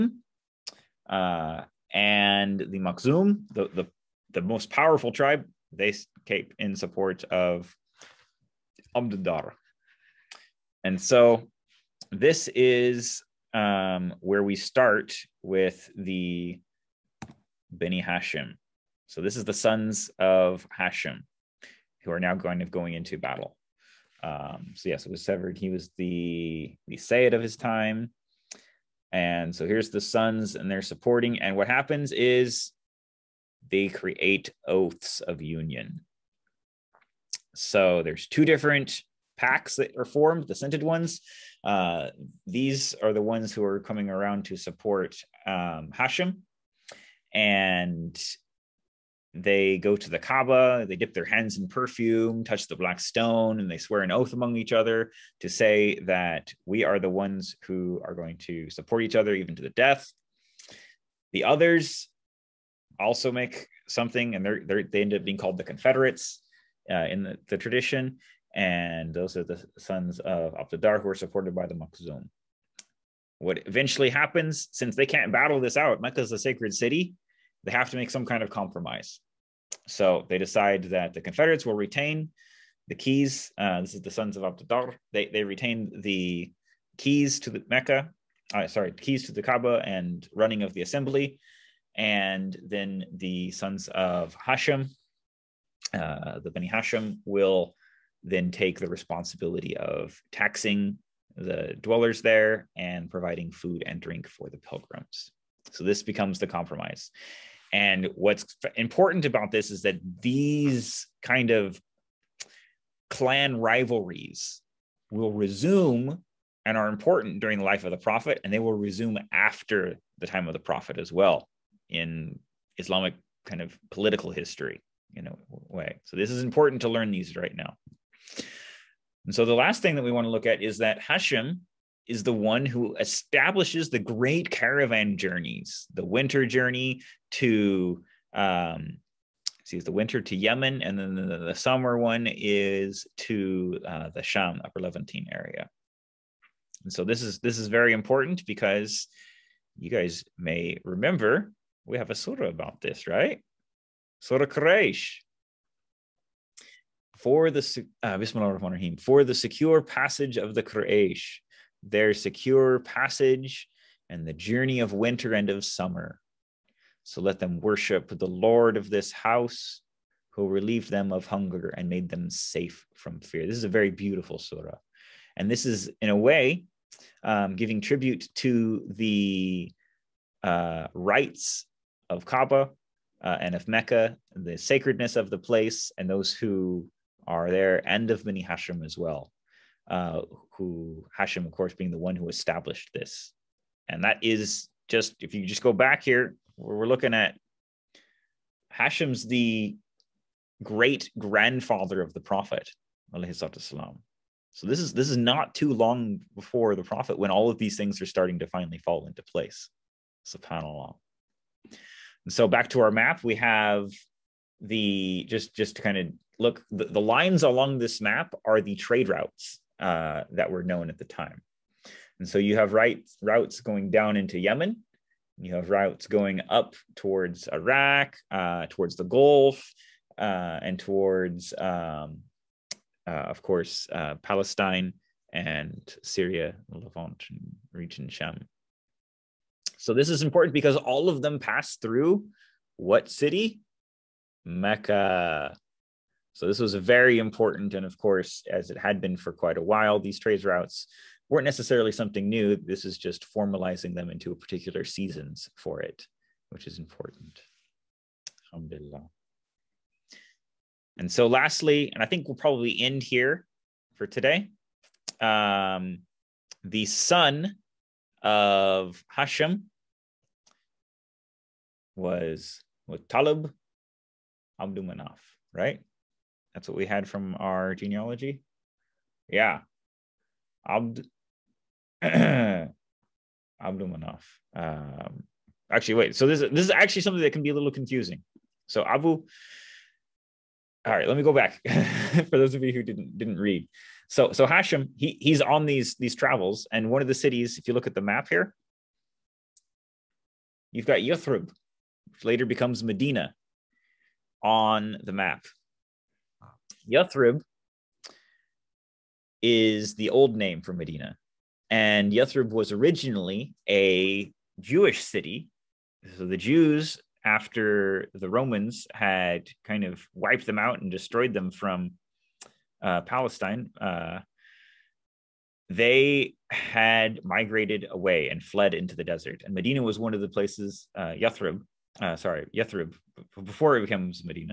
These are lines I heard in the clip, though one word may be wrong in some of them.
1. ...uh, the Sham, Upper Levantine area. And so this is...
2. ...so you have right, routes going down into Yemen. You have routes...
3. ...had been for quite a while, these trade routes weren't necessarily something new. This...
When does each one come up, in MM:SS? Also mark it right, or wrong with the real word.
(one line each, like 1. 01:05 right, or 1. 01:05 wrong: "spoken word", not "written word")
1. 02:23 right
2. 03:42 right
3. 04:08 right.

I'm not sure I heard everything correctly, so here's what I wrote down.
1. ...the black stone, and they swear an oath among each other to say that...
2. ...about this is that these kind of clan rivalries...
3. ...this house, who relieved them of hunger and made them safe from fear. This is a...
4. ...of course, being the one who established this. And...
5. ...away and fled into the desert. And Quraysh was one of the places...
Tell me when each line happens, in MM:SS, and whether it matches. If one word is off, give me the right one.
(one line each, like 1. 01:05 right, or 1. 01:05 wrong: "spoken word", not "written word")
1. 00:52 right
2. 01:49 right
3. 02:48 right
4. 03:11 right
5. 05:27 wrong: "Medina", not "Quraysh".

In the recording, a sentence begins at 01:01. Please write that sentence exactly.
The others also make something, and they're, they're, they end up being called the Confederates uh, in the, the, tradition.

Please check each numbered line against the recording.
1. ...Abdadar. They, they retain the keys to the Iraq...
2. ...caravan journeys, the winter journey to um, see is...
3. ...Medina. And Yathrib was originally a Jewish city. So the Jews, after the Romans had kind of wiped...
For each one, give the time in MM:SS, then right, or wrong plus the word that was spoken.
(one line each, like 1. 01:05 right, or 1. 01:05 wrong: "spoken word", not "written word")
1. 01:24 wrong: "Mecca", not "Iraq"
2. 02:14 right
3. 05:10 right.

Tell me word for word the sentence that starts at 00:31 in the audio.
And what happens is they create oaths of union.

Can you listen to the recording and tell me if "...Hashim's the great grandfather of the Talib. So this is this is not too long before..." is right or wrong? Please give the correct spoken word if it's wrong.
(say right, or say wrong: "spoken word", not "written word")
wrong: "Prophet", not "Talib".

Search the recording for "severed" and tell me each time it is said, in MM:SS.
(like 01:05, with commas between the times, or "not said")
00:25.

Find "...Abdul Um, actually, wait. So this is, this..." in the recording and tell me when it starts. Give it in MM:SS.
04:42.